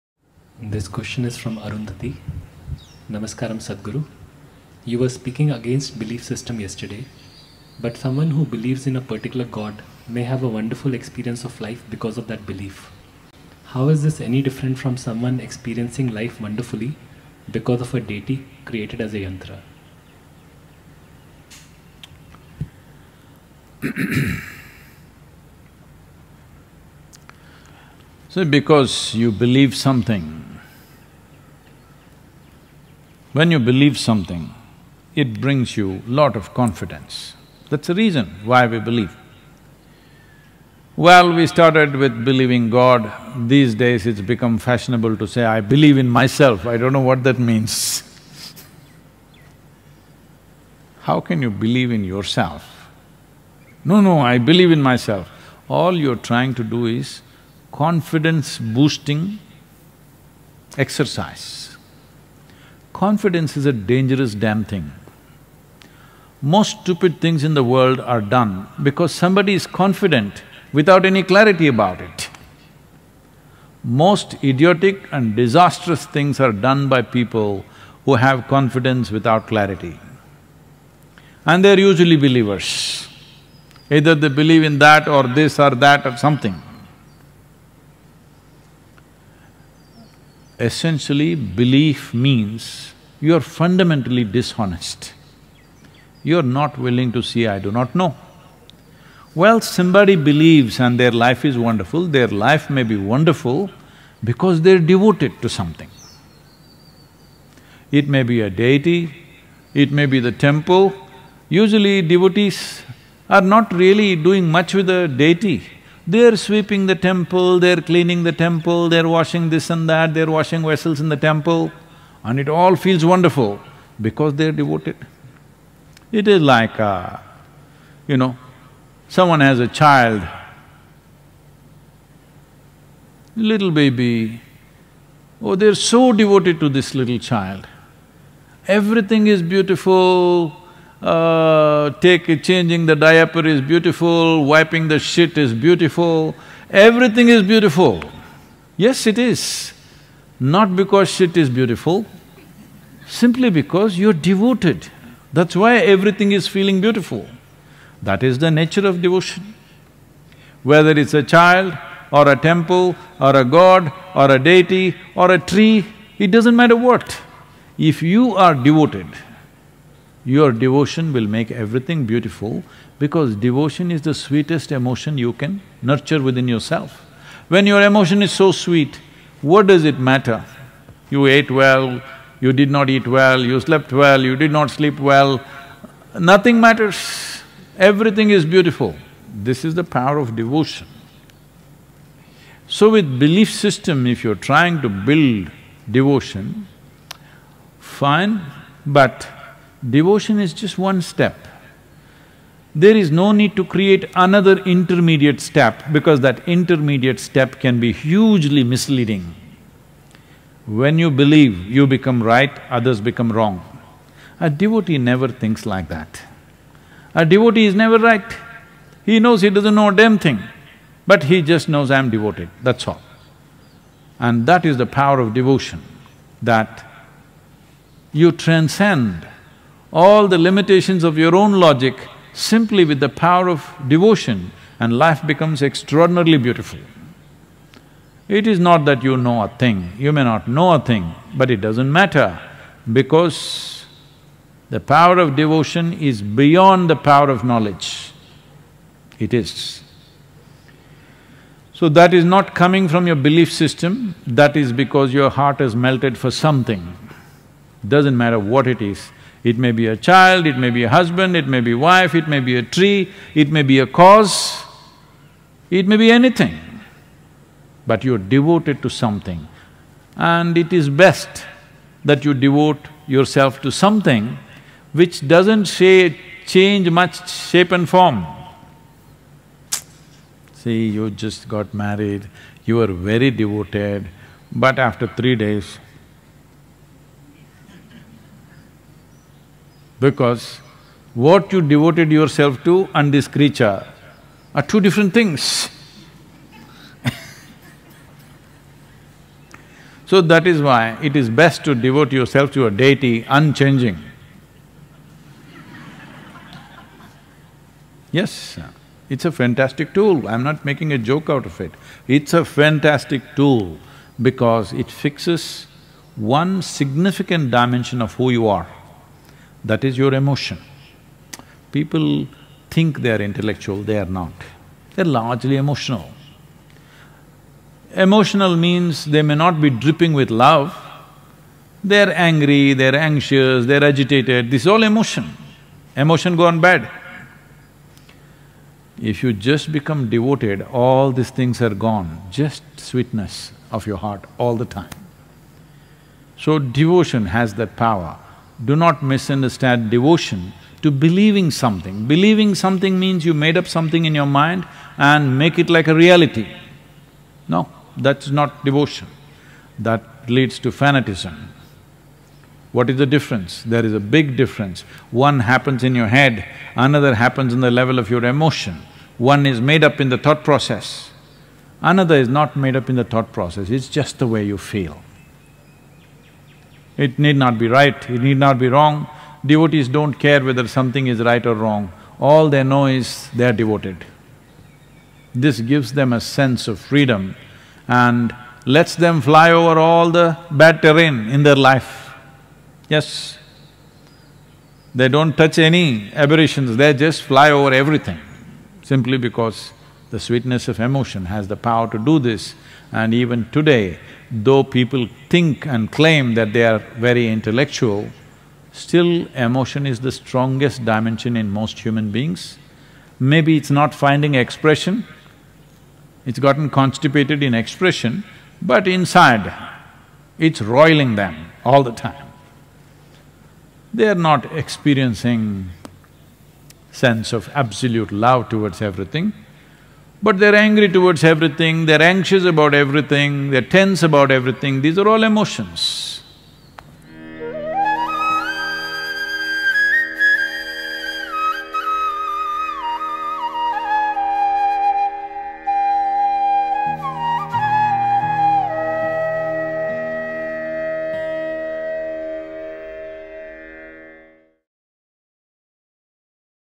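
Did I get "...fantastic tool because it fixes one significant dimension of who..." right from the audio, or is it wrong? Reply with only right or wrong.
right.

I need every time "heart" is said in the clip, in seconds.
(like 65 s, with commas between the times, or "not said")
255 s, 343 s.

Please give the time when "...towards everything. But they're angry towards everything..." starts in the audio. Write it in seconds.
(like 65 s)
428 s.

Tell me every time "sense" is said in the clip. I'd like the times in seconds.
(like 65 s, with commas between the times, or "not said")
386 s, 426 s.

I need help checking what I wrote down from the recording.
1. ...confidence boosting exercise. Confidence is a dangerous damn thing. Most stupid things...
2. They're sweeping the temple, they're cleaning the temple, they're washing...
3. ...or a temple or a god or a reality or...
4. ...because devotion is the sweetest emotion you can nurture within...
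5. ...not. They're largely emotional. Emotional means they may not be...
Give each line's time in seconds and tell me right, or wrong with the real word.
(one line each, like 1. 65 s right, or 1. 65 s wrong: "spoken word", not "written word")
1. 57 s right
2. 116 s right
3. 162 s wrong: "deity", not "reality"
4. 172 s right
5. 324 s right.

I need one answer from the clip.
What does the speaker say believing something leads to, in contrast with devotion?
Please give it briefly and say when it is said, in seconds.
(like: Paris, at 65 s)
fanatism, at 360 s.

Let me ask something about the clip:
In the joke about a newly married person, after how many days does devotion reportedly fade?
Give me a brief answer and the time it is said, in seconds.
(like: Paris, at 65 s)
3 days, at 285 s.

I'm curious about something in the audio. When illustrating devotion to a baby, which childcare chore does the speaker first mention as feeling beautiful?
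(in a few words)
changing the diaper.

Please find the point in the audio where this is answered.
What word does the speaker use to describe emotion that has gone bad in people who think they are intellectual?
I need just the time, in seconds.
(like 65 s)
416 s.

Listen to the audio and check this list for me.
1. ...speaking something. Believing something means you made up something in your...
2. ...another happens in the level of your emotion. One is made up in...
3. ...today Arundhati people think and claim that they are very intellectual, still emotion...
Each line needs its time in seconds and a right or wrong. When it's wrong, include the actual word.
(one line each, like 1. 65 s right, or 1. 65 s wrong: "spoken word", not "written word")
1. 350 s wrong: "believing", not "speaking"
2. 366 s right
3. 403 s wrong: "Though", not "Arundhati".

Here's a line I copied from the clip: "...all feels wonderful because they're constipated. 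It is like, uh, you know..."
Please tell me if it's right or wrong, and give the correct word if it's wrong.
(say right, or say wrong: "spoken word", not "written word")
wrong: "devoted", not "constipated".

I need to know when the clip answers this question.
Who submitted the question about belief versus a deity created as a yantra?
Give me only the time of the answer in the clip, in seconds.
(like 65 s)
1 s.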